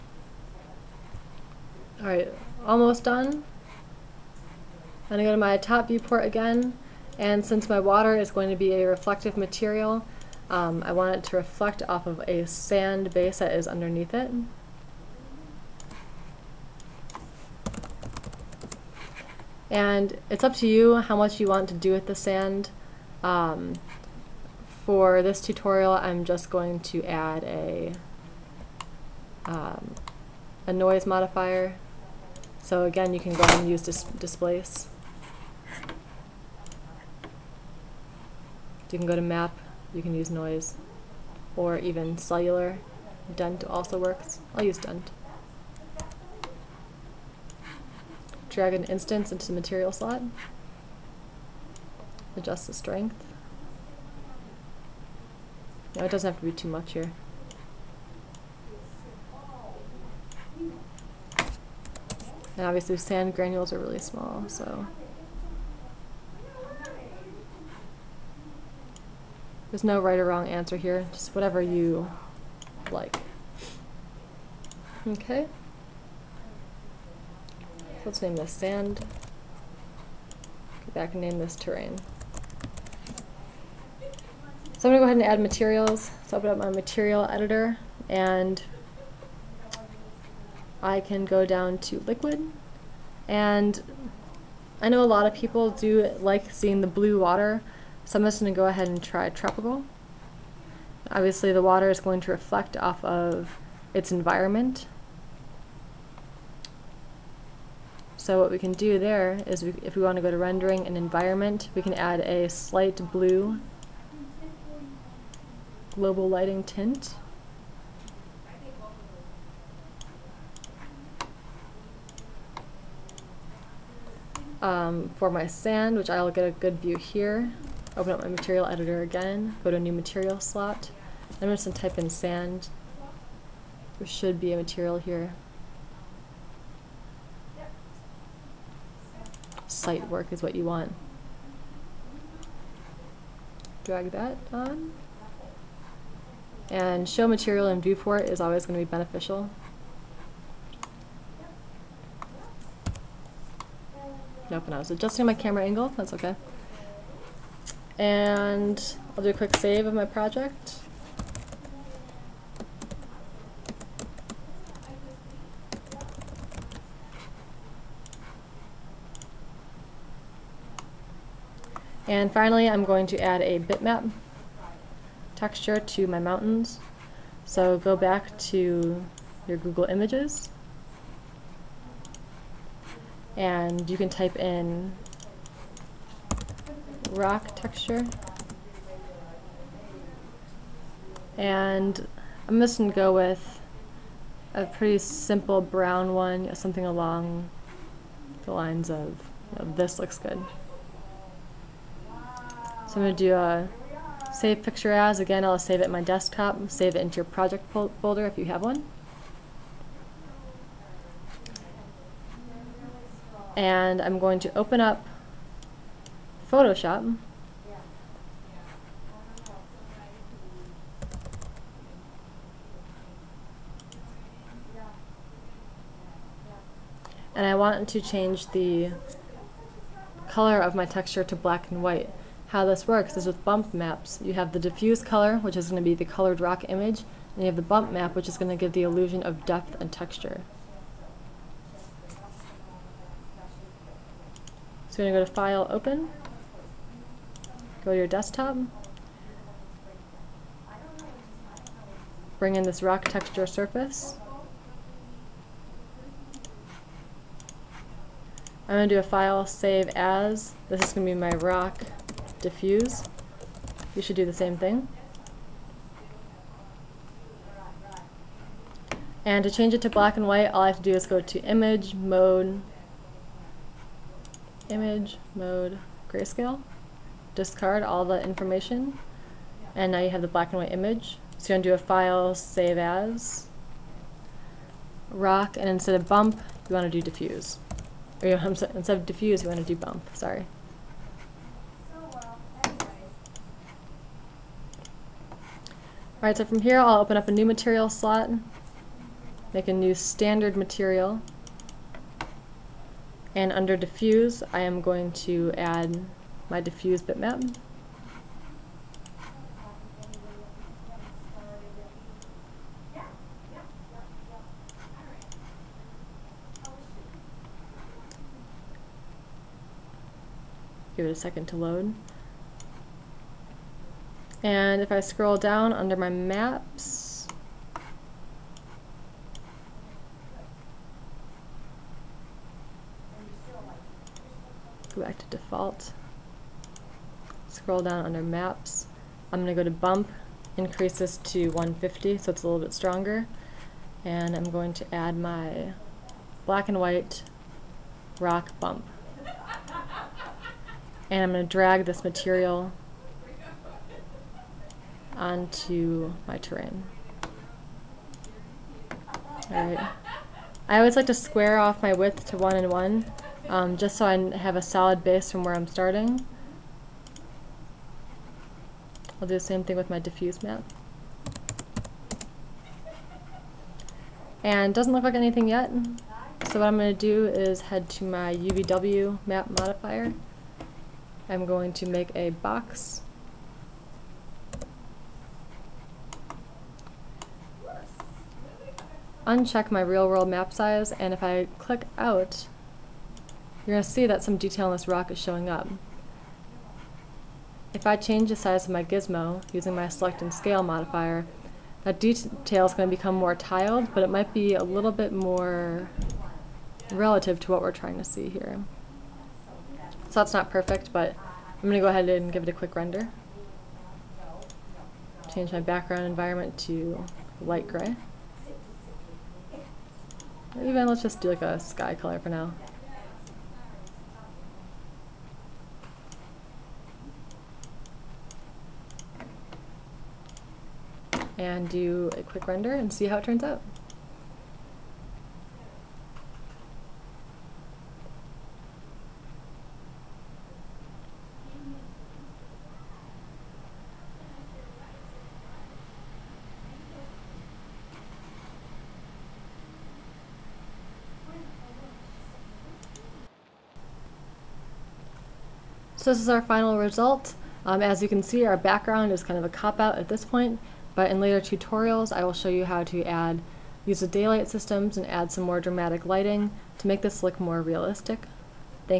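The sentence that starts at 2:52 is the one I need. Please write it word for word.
And finally, I'm going to add a bitmap texture to my mountains.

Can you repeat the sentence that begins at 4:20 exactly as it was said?
This is going to be my rock diffuse.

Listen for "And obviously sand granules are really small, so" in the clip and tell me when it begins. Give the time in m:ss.
1:02.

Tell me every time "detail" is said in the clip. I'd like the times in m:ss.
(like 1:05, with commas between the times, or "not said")
6:34, 6:41.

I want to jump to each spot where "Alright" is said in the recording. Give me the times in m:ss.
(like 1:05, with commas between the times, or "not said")
0:01, 4:56, 5:59.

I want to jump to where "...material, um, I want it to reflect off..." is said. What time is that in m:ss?
0:09.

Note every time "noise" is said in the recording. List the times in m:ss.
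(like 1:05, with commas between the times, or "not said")
0:30, 0:40.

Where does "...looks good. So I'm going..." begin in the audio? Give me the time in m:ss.
3:19.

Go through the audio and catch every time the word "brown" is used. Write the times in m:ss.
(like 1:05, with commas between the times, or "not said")
3:15.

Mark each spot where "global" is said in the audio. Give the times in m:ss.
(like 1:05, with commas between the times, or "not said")
1:55.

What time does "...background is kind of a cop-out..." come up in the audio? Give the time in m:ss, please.
7:38.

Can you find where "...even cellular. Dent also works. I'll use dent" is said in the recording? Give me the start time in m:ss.
0:41.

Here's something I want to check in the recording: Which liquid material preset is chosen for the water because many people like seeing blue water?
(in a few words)
Tropical.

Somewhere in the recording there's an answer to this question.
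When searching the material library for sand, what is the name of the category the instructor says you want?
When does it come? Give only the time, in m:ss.
2:19.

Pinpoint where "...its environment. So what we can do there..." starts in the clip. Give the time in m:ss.
1:43.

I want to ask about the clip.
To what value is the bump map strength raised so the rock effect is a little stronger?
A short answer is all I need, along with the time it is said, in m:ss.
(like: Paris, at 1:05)
150, at 5:41.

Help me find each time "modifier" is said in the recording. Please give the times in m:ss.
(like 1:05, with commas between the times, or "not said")
0:31, 6:19, 6:40.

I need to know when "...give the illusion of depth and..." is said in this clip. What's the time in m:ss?
3:58.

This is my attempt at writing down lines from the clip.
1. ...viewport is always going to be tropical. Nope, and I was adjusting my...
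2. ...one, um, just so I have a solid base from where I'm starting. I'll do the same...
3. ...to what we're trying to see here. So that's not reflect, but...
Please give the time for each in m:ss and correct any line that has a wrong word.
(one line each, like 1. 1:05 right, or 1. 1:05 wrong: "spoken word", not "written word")
1. 2:27 wrong: "beneficial", not "tropical"
2. 6:02 right
3. 6:47 wrong: "perfect", not "reflect".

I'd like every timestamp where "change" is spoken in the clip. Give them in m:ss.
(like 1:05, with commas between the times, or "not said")
3:48, 4:29, 6:37, 6:55.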